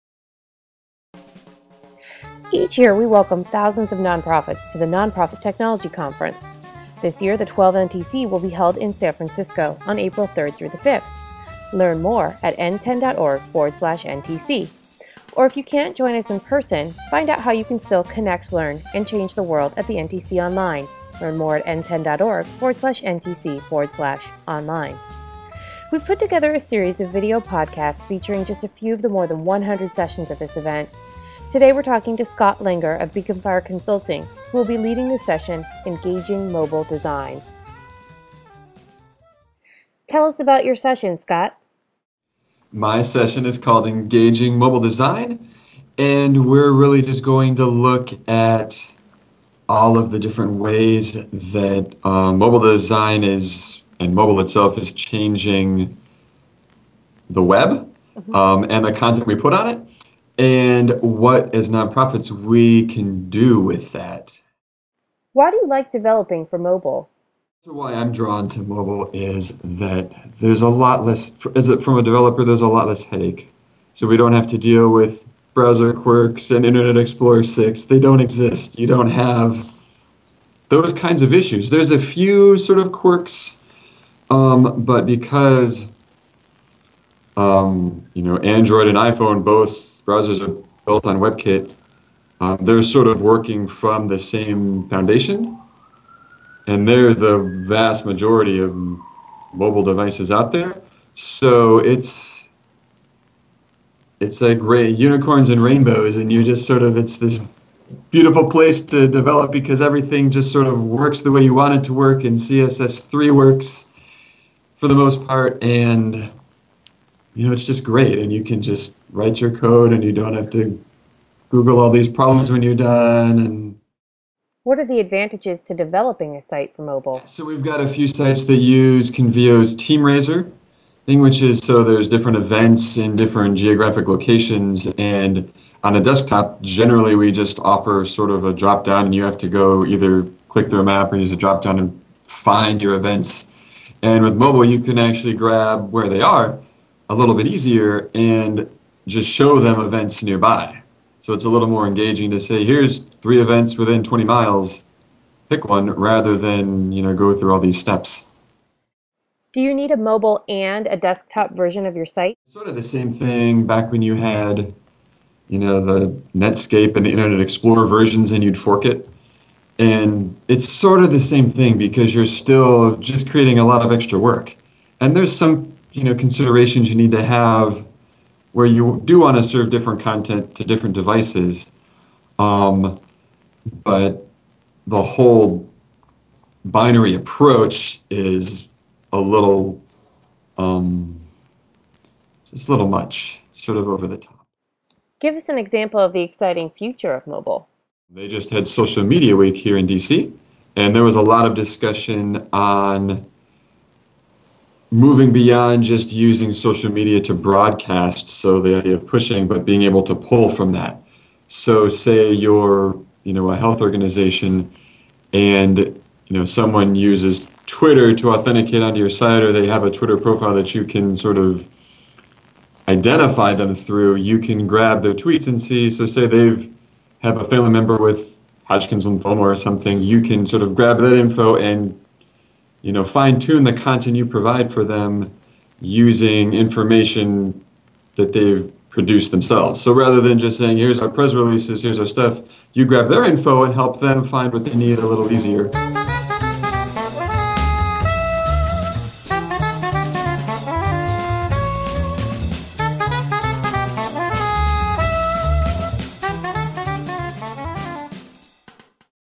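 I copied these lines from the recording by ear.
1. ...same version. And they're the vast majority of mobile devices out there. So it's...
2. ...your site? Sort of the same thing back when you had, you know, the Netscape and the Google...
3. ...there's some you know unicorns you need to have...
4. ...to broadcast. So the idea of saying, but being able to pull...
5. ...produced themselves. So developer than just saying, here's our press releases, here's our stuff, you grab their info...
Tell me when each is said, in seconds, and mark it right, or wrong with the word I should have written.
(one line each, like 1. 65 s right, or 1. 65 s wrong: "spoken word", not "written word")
1. 94 s wrong: "foundation", not "version"
2. 161 s wrong: "Internet", not "Google"
3. 175 s wrong: "considerations", not "unicorns"
4. 207 s wrong: "pushing", not "saying"
5. 238 s wrong: "rather", not "developer".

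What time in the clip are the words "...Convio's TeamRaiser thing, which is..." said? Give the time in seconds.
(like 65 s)
129 s.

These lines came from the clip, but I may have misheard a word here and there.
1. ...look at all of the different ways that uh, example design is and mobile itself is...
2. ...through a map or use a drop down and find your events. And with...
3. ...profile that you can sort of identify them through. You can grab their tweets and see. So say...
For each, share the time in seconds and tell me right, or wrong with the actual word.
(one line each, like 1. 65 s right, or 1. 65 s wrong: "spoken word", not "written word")
1. 47 s wrong: "mobile", not "example"
2. 140 s right
3. 220 s right.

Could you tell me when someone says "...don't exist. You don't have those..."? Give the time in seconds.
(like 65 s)
77 s.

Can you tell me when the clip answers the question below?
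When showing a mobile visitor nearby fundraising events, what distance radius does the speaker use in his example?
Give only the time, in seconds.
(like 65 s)
154 s.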